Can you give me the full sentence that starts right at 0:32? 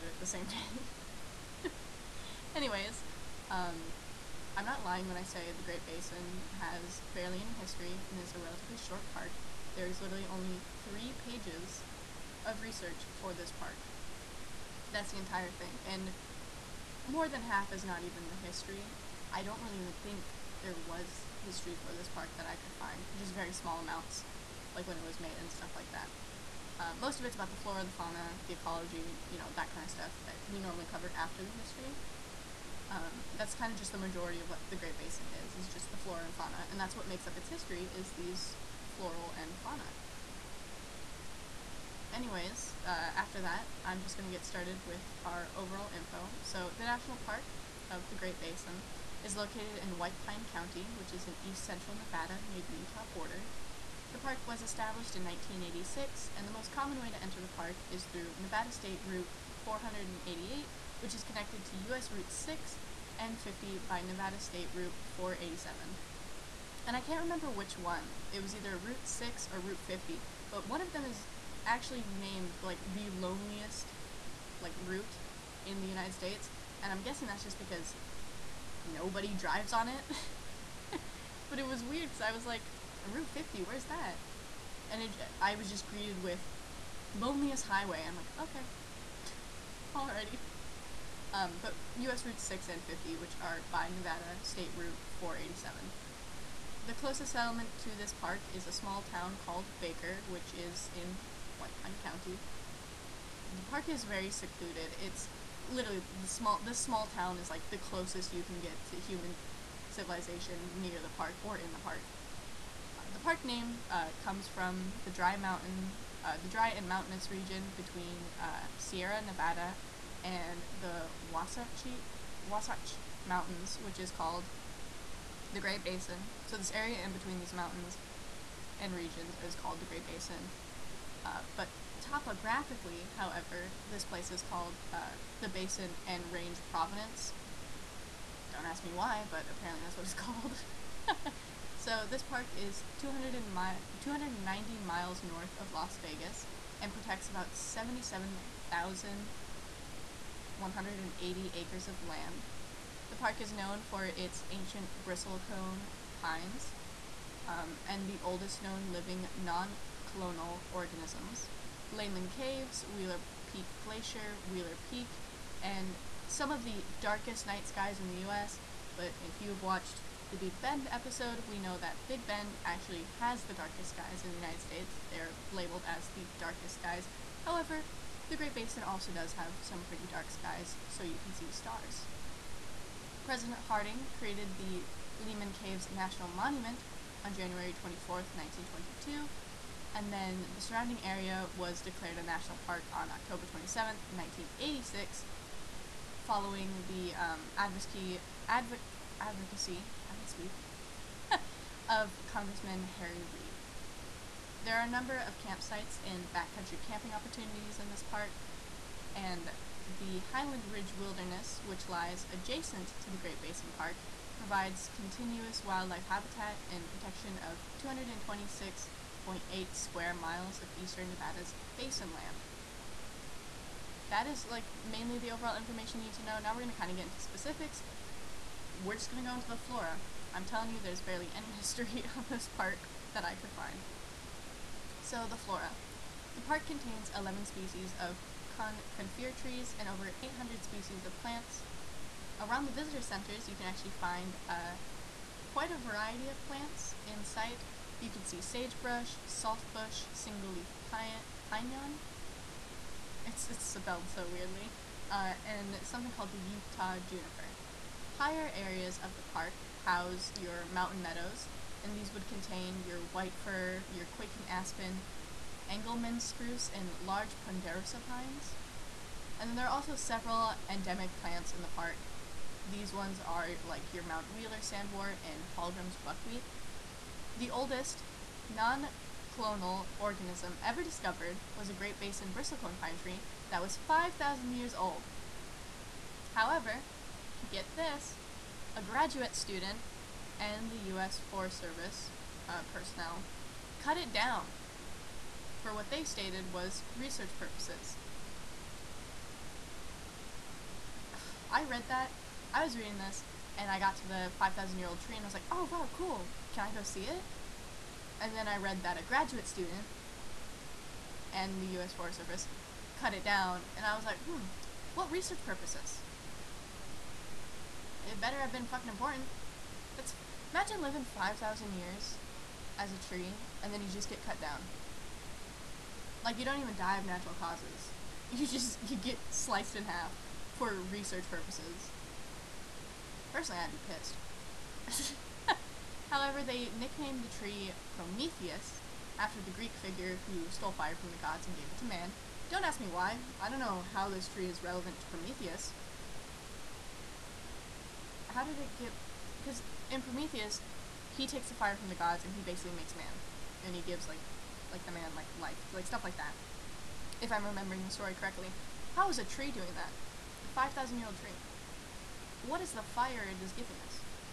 Um, that's kind of just the majority of what the Great Basin is, is just the flora and fauna.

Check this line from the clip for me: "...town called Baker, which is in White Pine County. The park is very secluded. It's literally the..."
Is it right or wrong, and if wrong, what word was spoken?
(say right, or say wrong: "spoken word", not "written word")
right.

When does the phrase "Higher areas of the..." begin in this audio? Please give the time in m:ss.
4:18.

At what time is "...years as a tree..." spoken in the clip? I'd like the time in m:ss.
5:21.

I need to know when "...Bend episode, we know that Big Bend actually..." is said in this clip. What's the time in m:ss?
2:50.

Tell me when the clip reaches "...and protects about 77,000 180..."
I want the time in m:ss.
2:26.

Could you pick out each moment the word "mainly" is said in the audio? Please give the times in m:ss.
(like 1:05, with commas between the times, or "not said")
3:44.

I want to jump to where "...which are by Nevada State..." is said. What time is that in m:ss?
1:33.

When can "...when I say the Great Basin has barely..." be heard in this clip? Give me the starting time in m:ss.
0:05.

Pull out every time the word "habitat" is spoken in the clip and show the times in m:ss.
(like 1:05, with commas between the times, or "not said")
3:36.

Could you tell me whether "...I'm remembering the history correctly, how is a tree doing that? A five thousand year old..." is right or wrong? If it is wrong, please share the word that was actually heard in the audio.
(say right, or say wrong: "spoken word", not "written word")
wrong: "story", not "history".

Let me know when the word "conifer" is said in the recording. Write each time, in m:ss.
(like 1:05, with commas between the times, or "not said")
3:58.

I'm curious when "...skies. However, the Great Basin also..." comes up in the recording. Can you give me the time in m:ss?
2:56.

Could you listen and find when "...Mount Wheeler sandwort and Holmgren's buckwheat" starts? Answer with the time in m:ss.
4:34.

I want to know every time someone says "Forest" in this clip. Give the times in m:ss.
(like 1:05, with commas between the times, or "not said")
4:51, 5:11.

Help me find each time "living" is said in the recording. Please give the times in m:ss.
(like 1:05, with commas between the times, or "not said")
2:38, 5:20.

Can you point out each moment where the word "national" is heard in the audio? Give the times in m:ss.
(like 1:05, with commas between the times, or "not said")
0:46, 3:05, 3:12.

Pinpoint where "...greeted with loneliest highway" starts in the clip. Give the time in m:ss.
1:25.